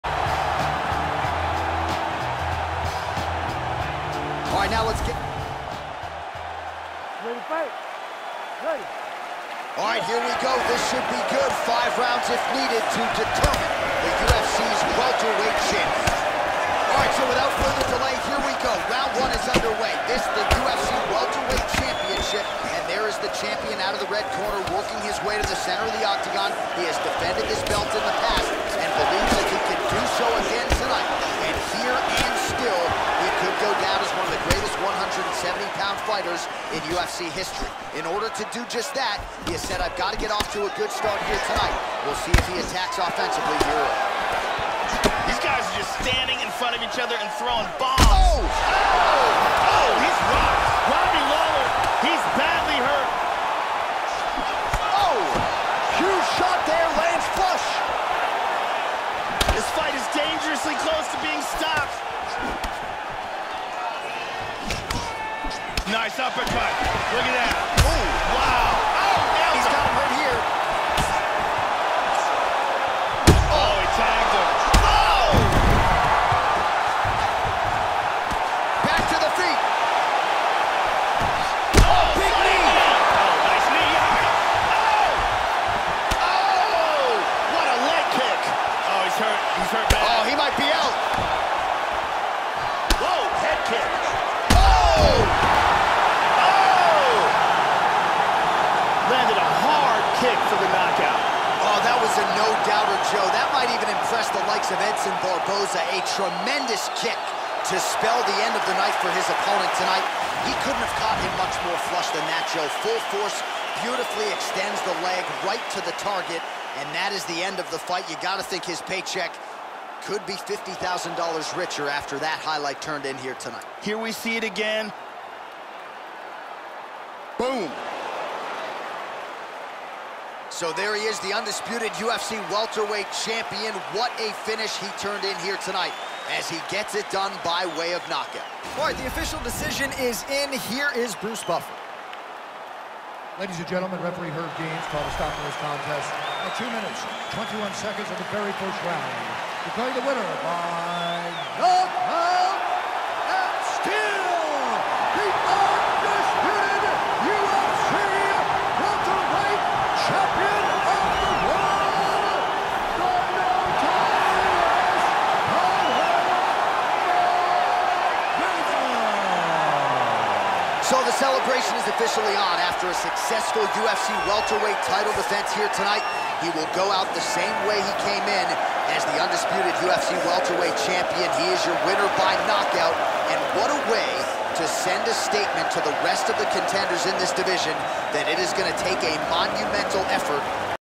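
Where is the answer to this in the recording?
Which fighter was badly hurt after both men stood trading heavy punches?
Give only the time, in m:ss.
0:50.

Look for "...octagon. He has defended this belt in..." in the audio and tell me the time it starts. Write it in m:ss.
0:26.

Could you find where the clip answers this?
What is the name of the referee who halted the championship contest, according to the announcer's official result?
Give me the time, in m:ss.
2:24.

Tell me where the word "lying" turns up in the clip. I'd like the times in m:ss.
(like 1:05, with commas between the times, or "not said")
not said.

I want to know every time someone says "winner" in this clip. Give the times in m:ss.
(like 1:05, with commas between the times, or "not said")
2:30, 3:01.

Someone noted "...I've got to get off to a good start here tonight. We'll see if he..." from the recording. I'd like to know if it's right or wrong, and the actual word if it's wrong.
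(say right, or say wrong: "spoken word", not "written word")
right.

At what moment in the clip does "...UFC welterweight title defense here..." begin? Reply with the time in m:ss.
2:53.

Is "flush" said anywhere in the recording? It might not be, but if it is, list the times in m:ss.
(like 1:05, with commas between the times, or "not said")
0:57, 1:51.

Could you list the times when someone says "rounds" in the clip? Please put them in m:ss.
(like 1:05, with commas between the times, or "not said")
0:11, 0:18, 2:28.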